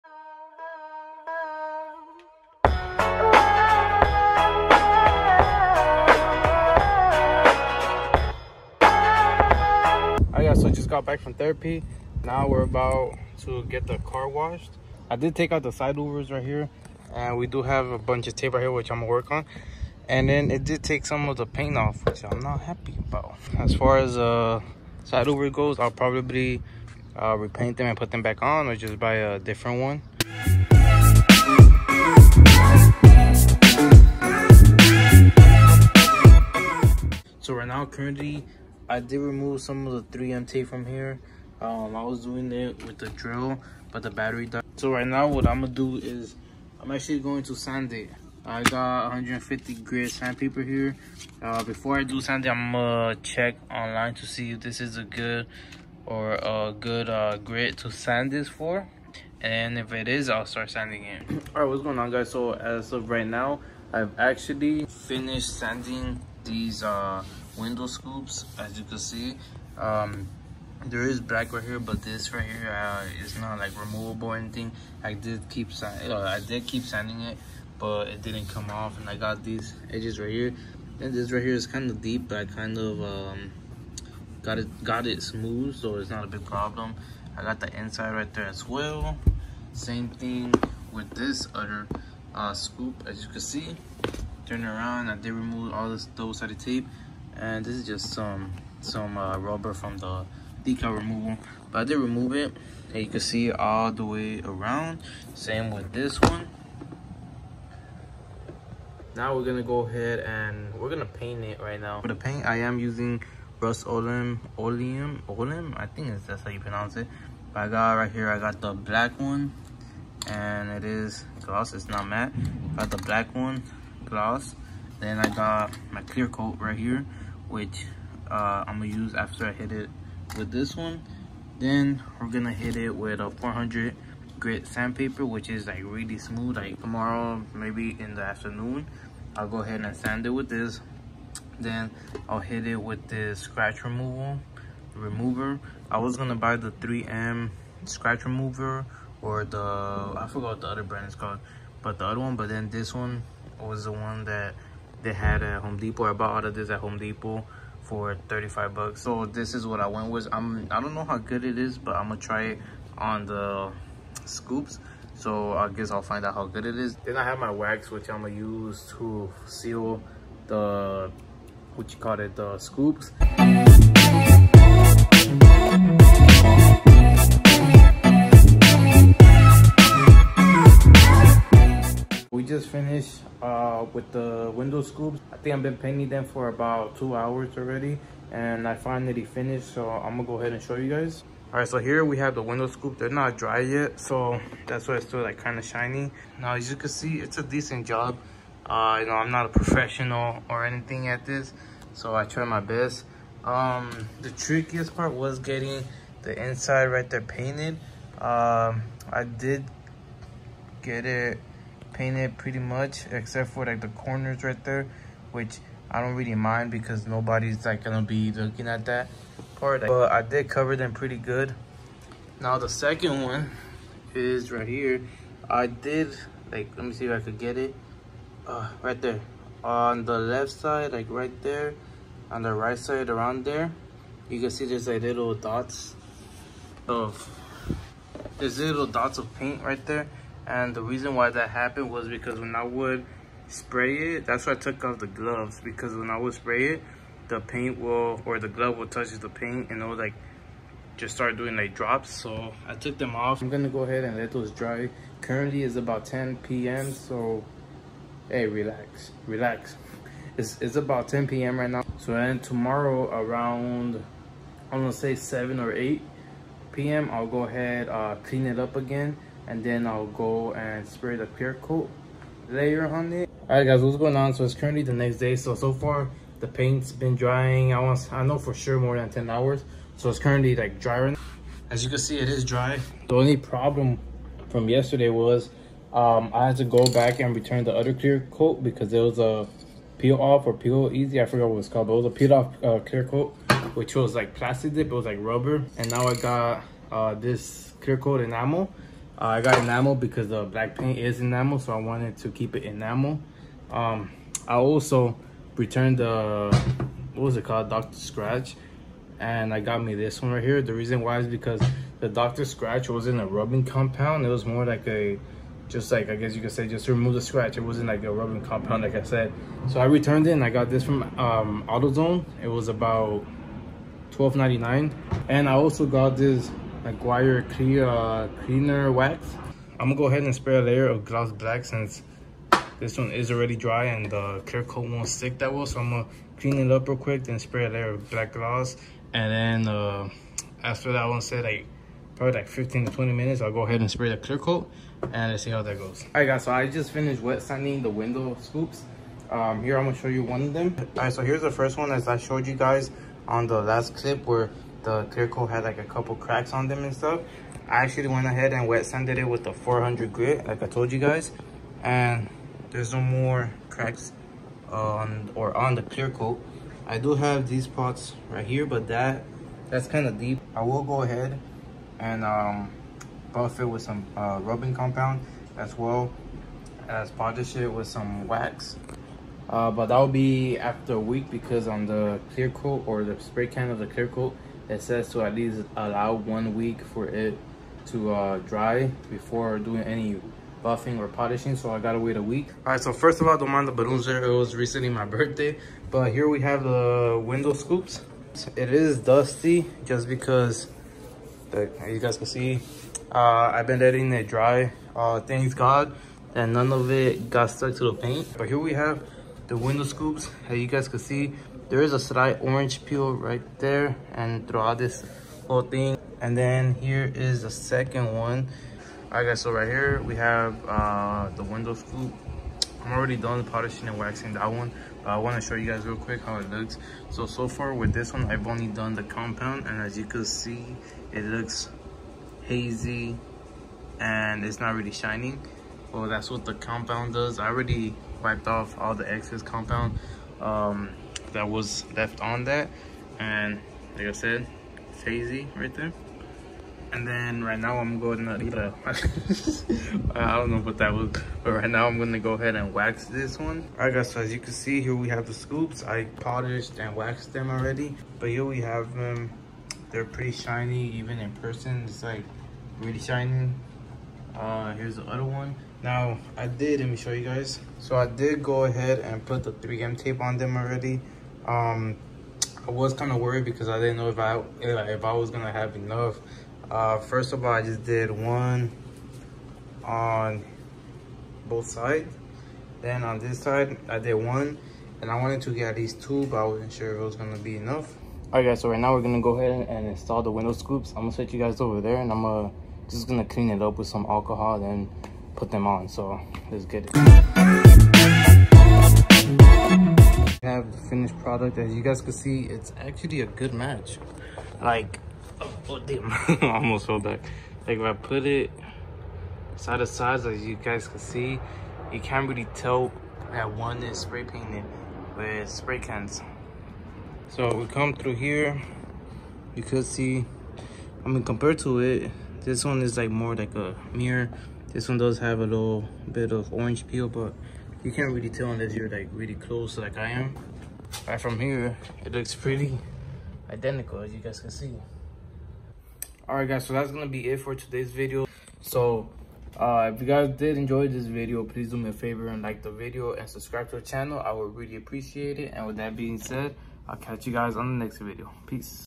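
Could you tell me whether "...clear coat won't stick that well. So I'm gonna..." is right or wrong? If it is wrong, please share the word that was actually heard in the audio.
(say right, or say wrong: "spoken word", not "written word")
right.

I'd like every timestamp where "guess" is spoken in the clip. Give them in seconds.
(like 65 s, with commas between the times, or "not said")
165 s, 316 s.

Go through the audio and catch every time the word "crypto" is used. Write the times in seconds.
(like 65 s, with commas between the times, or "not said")
not said.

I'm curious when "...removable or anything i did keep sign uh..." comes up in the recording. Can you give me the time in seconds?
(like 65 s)
73 s.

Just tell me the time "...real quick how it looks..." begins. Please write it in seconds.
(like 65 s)
425 s.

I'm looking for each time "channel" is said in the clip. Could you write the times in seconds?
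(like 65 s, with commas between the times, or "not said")
543 s.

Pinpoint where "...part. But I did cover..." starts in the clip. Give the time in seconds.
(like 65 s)
219 s.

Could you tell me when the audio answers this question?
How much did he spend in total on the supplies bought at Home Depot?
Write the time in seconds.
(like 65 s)
158 s.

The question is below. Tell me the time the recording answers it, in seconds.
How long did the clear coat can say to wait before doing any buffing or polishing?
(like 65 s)
386 s.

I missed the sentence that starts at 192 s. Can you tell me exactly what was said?
They're not dry yet, so that's why it's still like kind of shiny.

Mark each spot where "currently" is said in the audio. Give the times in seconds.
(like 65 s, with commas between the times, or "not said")
37 s, 255 s, 274 s, 280 s.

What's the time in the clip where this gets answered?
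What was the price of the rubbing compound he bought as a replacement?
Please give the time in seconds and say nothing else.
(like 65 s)
324 s.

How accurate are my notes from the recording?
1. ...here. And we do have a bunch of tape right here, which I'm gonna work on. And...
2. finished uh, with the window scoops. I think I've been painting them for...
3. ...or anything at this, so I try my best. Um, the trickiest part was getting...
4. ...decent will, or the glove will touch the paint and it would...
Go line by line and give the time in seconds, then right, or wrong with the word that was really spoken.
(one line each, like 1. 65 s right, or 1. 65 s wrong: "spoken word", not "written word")
1. 16 s right
2. 182 s right
3. 200 s right
4. 247 s wrong: "paint", not "decent".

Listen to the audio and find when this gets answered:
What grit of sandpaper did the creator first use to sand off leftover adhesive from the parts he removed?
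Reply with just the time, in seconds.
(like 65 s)
49 s.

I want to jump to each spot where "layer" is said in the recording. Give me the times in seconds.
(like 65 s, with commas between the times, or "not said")
272 s, 330 s, 337 s.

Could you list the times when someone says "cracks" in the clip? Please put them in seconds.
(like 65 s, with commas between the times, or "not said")
356 s, 363 s.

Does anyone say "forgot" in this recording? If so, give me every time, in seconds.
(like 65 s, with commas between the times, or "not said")
150 s, 291 s.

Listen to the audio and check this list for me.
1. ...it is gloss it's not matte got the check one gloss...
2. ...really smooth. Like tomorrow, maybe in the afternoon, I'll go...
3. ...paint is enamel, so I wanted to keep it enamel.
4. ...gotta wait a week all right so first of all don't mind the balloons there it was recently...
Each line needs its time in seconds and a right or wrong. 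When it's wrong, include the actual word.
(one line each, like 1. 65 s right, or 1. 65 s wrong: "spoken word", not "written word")
1. 120 s wrong: "black", not "check"
2. 135 s right
3. 300 s right
4. 391 s right.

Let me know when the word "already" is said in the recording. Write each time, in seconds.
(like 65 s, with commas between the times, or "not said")
187 s, 333 s, 422 s, 437 s, 457 s, 470 s.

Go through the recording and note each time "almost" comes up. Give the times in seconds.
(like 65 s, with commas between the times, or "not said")
506 s.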